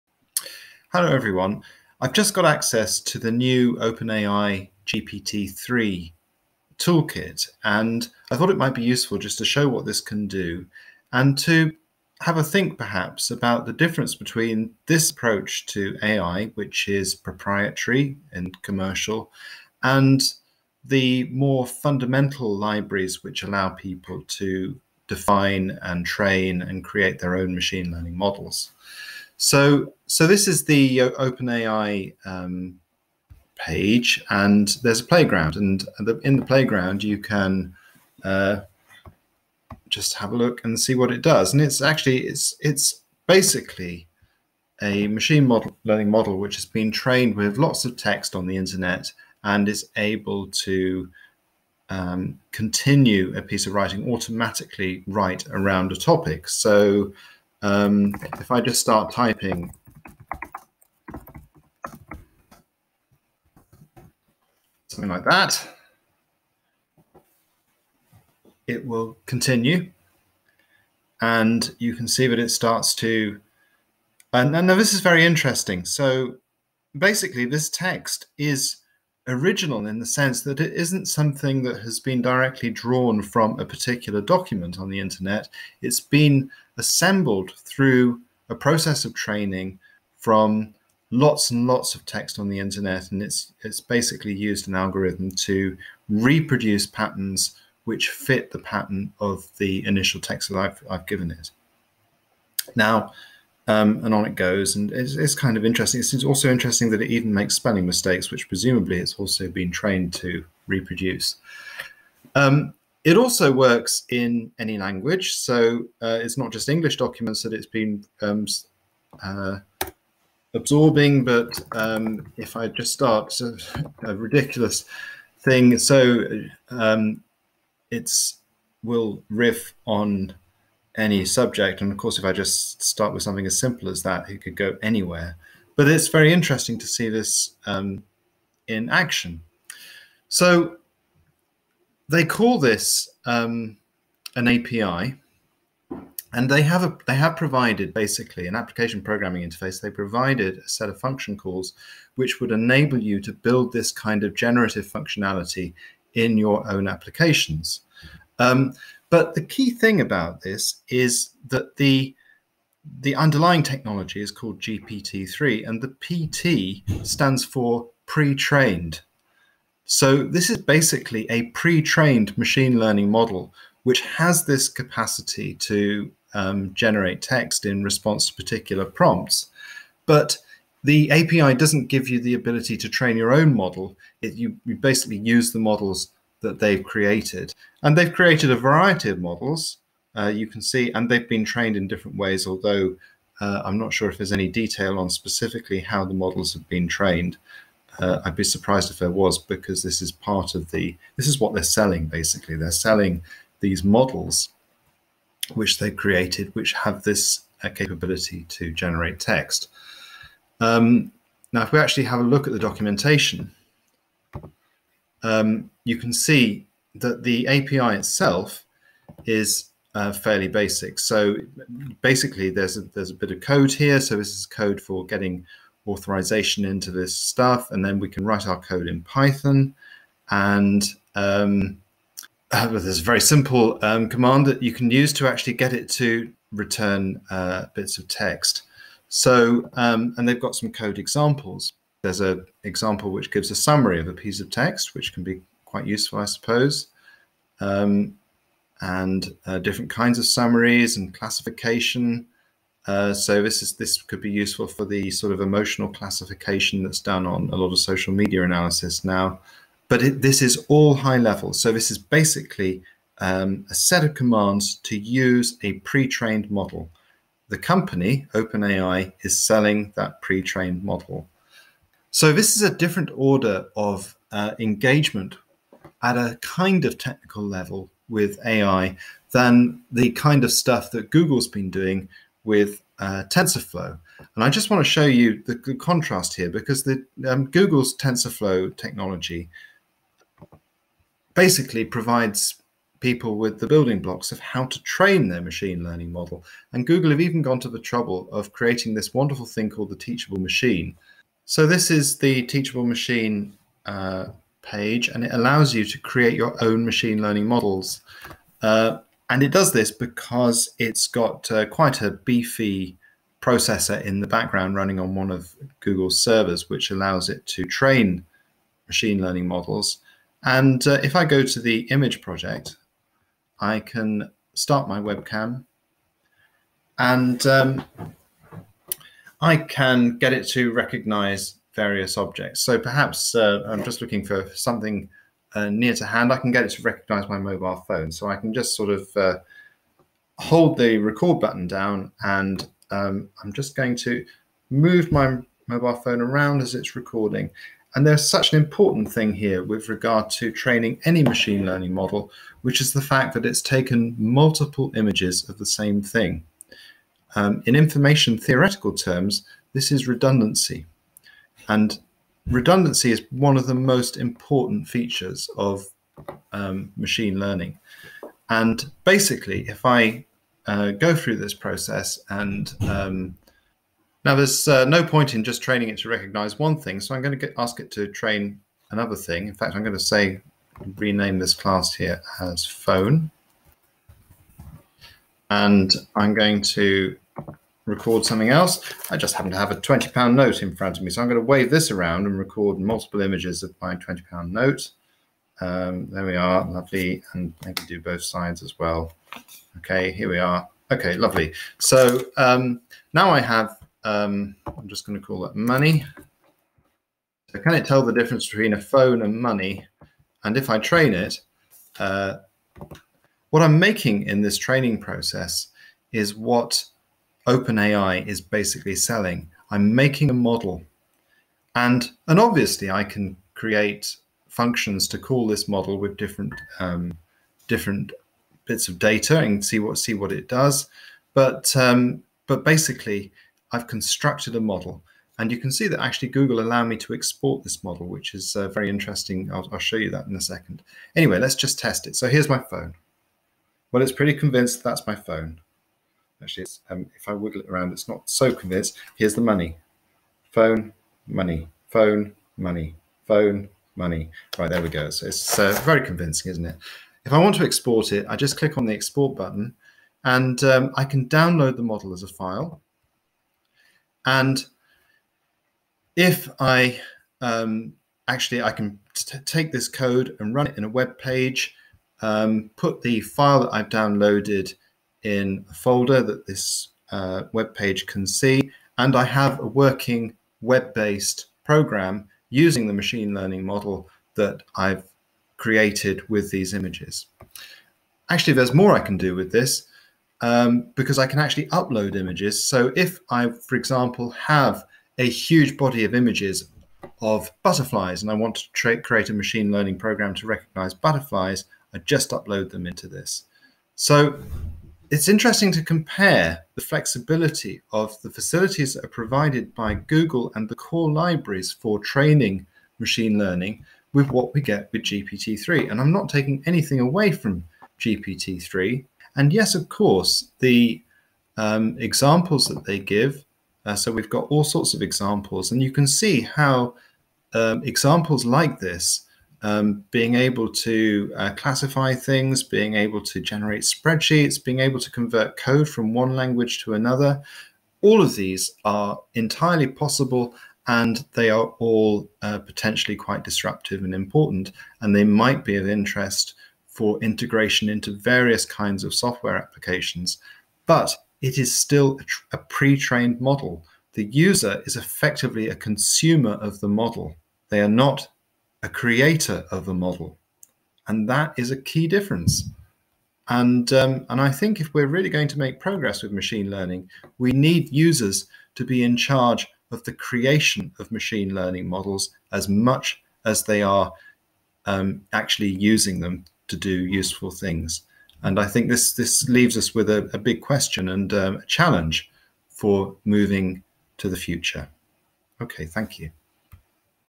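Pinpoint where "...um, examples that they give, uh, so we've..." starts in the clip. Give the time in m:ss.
8:41.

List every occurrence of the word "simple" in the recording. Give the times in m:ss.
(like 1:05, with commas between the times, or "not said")
2:13, 3:53.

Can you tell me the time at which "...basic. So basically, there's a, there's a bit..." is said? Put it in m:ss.
3:40.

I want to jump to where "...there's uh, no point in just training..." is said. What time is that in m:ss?
6:14.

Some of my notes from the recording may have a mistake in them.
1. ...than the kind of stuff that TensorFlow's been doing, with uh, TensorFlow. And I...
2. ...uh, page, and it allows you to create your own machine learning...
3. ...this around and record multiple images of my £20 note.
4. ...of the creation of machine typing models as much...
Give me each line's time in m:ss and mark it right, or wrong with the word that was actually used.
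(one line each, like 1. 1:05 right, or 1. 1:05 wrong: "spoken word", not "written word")
1. 4:39 wrong: "Google", not "TensorFlow"
2. 5:03 right
3. 6:31 right
4. 9:29 wrong: "learning", not "typing".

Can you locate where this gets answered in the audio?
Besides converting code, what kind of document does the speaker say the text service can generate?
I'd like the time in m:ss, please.
8:53.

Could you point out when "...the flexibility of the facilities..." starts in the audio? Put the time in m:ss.
8:26.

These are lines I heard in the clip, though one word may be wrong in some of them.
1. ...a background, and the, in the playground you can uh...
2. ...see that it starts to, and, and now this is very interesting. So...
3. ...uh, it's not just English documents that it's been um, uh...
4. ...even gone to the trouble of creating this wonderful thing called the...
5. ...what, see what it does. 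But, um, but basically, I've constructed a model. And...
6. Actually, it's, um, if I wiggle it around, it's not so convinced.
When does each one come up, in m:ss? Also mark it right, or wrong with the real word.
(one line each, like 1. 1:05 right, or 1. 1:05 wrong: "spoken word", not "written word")
1. 0:35 wrong: "playground", not "background"
2. 1:12 right
3. 1:56 right
4. 4:57 right
5. 7:09 right
6. 7:26 right.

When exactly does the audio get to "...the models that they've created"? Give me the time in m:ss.
3:05.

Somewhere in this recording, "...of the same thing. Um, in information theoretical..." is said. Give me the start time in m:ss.
5:55.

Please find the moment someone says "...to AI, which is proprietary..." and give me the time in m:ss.
0:15.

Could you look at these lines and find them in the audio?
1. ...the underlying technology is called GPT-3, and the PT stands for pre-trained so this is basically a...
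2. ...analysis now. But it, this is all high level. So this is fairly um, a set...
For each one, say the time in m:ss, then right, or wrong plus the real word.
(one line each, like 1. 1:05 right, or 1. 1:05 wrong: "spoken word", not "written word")
1. 2:43 right
2. 4:18 wrong: "basically", not "fairly".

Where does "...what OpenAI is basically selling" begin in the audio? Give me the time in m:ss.
6:56.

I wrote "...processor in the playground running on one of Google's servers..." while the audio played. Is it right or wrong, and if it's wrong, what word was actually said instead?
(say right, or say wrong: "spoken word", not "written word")
wrong: "background", not "playground".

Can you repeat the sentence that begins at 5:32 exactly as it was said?
So perhaps uh, I'm just looking for something uh, near to hand, I can get it to recognize my mobile phone.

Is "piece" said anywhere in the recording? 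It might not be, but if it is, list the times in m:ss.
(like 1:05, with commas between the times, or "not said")
0:53, 4:04.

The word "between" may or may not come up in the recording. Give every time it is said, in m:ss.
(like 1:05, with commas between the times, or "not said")
0:14, 6:48.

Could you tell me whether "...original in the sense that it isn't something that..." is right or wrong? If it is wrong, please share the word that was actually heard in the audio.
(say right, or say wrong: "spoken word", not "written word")
right.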